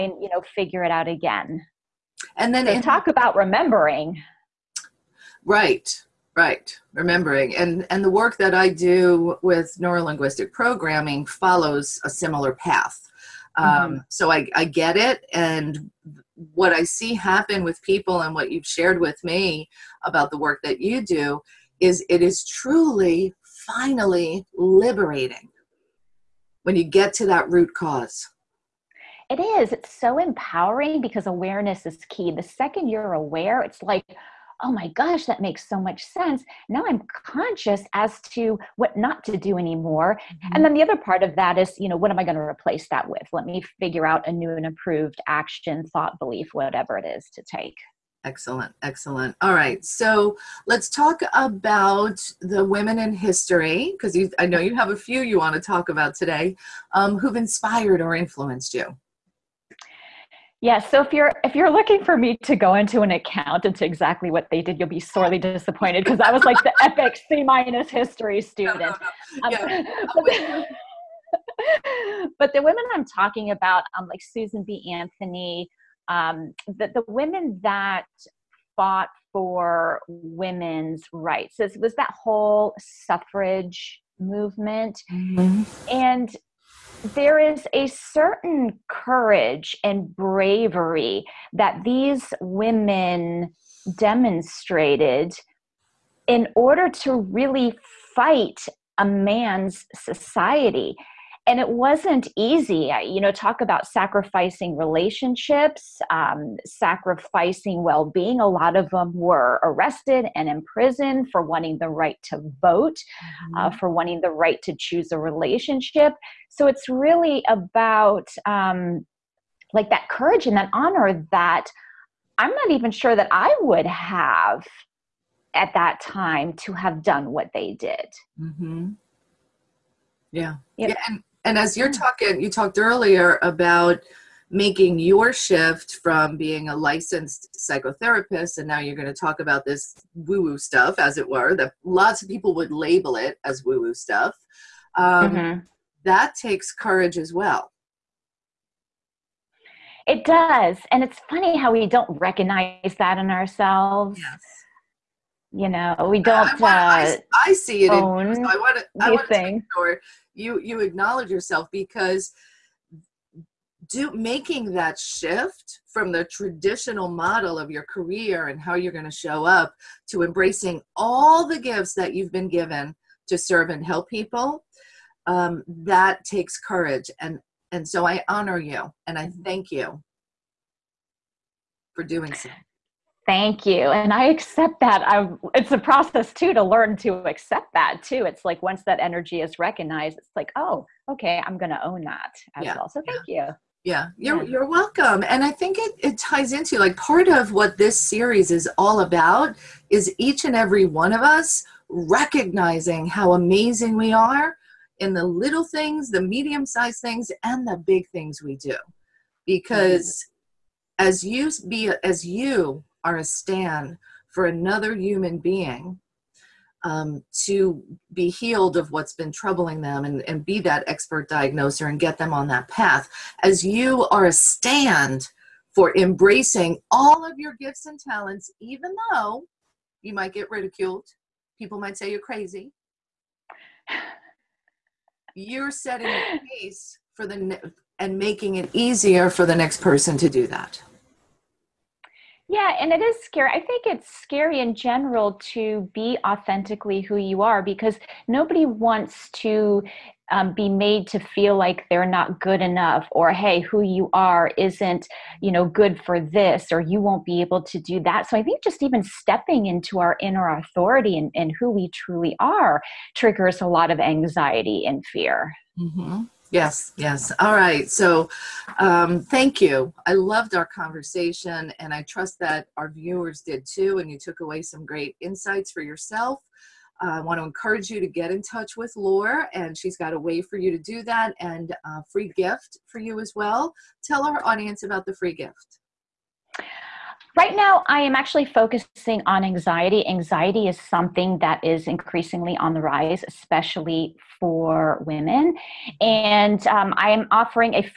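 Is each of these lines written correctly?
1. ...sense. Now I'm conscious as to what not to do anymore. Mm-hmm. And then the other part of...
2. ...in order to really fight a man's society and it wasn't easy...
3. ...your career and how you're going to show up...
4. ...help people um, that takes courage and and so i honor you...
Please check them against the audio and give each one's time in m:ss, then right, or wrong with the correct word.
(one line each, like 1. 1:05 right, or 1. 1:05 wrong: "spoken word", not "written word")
1. 0:36 right
2. 1:36 right
3. 2:47 right
4. 2:53 right.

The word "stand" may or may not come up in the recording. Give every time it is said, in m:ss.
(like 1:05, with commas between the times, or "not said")
3:33, 3:44.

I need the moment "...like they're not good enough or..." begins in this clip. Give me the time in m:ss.
4:11.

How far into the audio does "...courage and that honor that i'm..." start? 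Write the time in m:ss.
2:00.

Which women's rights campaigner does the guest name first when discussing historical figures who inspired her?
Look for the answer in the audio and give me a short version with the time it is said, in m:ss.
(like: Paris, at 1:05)
Susan B. Anthony, at 1:14.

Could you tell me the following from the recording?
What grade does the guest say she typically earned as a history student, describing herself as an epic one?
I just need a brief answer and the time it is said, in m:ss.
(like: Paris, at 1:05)
C minus, at 1:07.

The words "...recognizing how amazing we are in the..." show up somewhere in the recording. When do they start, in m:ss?
3:21.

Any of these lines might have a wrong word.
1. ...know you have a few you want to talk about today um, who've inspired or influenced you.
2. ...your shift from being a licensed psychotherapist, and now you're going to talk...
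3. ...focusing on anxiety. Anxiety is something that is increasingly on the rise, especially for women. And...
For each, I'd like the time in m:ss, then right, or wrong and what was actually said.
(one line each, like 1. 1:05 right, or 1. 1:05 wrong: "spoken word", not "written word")
1. 0:54 right
2. 2:14 right
3. 4:48 right.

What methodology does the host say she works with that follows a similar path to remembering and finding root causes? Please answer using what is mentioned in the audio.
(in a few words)
Neurolinguistic programming.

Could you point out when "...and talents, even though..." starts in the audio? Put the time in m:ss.
3:47.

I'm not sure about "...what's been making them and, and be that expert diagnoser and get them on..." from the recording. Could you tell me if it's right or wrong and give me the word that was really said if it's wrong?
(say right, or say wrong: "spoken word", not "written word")
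wrong: "troubling", not "making".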